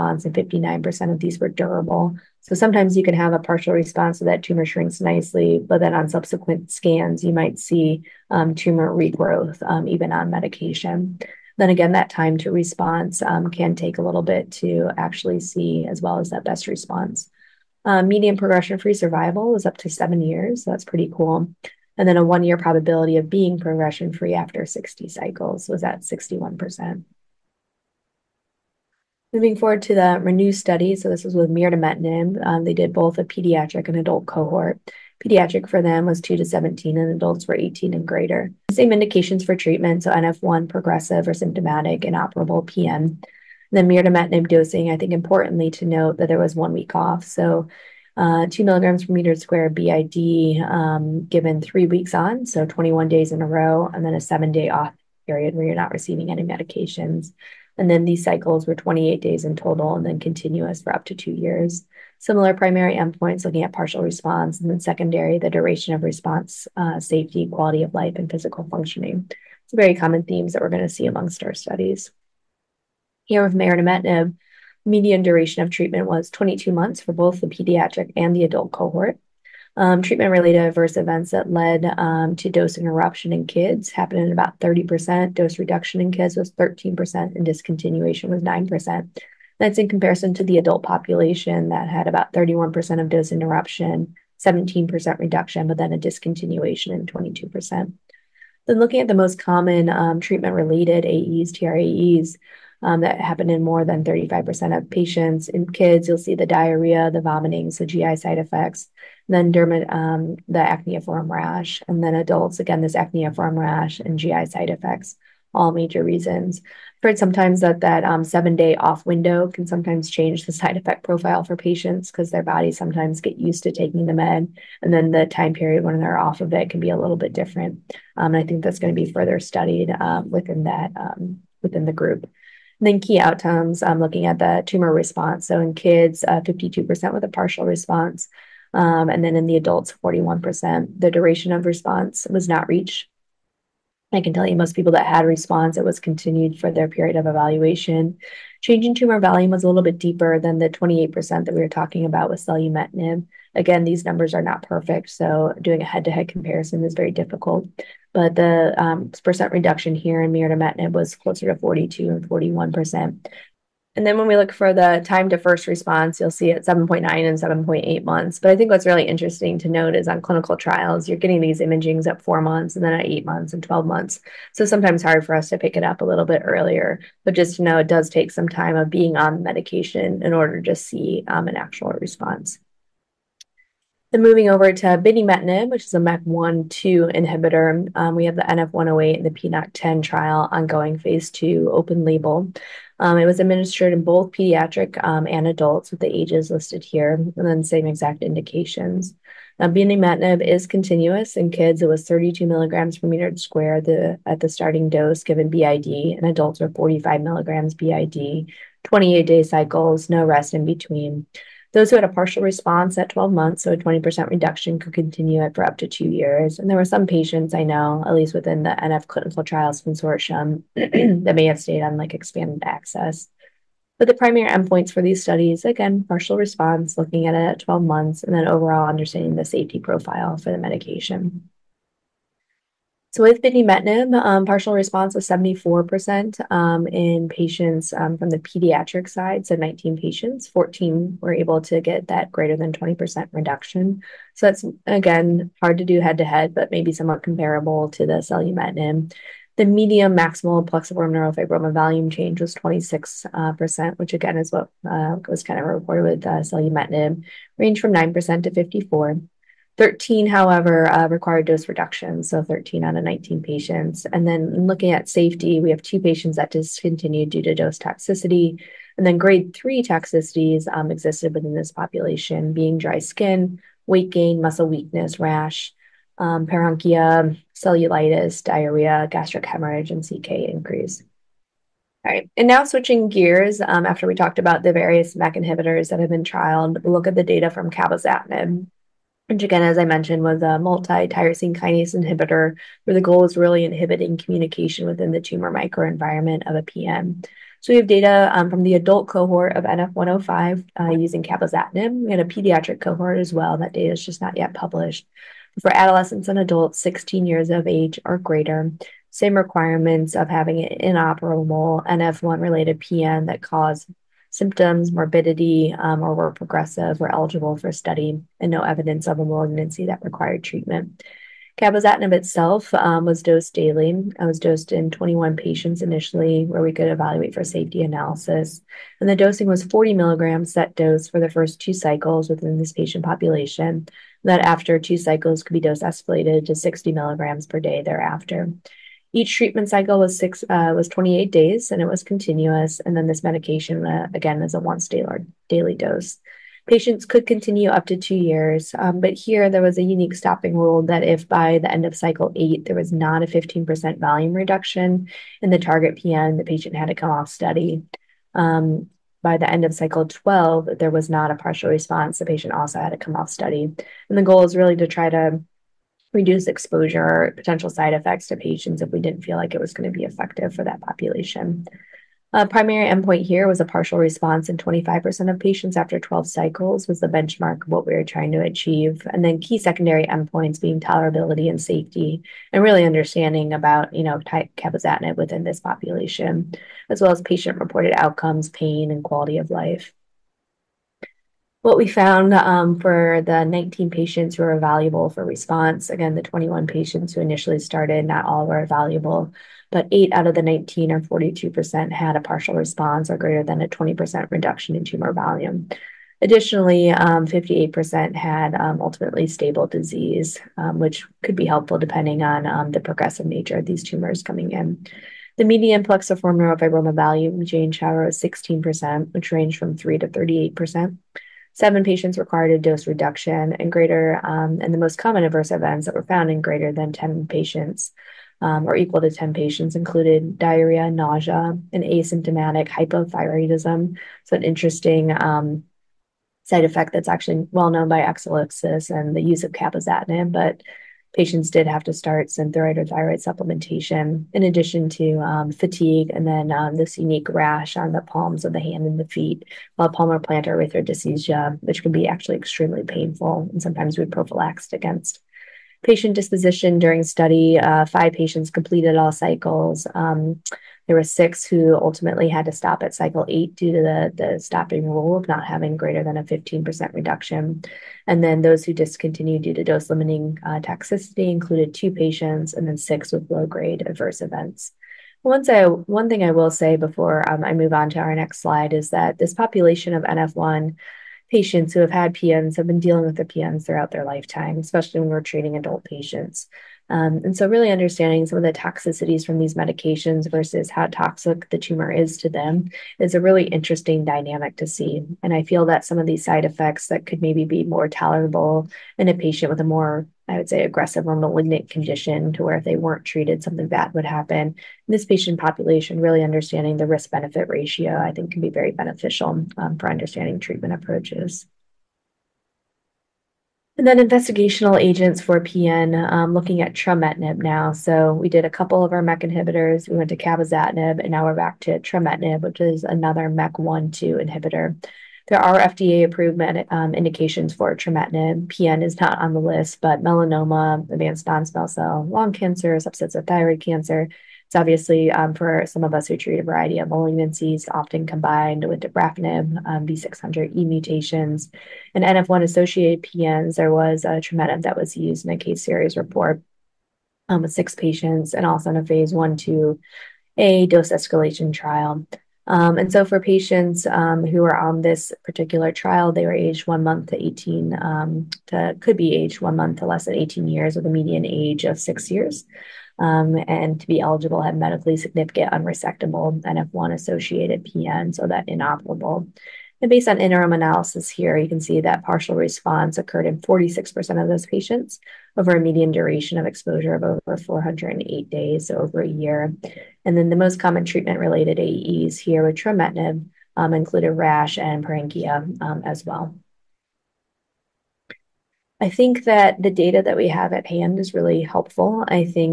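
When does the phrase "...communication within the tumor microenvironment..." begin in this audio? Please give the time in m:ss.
4:54.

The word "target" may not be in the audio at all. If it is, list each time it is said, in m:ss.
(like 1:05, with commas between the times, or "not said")
5:55.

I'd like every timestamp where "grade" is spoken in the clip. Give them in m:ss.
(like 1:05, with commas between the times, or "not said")
4:29, 7:53.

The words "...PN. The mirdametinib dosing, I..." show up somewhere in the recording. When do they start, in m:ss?
0:42.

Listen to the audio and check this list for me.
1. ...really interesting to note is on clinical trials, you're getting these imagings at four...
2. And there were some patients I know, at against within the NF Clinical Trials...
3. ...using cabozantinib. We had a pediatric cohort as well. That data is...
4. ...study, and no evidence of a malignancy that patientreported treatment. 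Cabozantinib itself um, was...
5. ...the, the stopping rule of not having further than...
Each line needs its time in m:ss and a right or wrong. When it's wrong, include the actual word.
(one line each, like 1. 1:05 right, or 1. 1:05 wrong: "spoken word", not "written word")
1. 2:48 right
2. 3:36 wrong: "least", not "against"
3. 5:00 right
4. 5:17 wrong: "required", not "patientreported"
5. 7:43 wrong: "greater", not "further".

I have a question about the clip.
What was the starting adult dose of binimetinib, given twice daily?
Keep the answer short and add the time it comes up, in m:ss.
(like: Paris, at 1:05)
45 milligrams, at 3:26.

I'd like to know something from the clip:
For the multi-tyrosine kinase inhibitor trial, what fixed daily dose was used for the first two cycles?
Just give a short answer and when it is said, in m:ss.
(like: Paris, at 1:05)
40 milligrams, at 5:29.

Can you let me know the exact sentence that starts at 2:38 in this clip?
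But the um, percent reduction here in mirdametinib was closer to 42 and 41%.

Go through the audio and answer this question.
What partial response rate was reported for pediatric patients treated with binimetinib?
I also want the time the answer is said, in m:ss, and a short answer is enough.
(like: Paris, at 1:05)
74%, at 3:55.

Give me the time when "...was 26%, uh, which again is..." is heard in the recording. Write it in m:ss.
4:12.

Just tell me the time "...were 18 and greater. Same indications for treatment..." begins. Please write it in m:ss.
0:37.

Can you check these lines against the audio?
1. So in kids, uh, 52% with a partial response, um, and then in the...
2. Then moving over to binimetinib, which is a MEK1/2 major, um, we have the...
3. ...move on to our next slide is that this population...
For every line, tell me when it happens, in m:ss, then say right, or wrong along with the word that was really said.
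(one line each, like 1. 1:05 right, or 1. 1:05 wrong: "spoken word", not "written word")
1. 2:15 right
2. 3:04 wrong: "inhibitor", not "major"
3. 7:57 right.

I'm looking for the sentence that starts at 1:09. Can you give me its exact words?
It's very common themes that we're going to see amongst our studies.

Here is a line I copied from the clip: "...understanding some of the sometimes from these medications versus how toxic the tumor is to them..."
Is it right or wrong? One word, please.
wrong.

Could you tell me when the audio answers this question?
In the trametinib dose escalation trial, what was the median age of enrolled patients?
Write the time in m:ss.
9:21.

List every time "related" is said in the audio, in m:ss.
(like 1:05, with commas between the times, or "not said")
1:20, 1:40, 5:12, 9:41.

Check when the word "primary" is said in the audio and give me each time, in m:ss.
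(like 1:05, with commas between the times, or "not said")
1:02, 3:44, 6:12.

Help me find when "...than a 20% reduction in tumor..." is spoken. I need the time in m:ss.
6:43.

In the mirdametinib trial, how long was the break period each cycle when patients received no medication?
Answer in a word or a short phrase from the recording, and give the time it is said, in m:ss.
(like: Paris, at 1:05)
7 days, at 0:54.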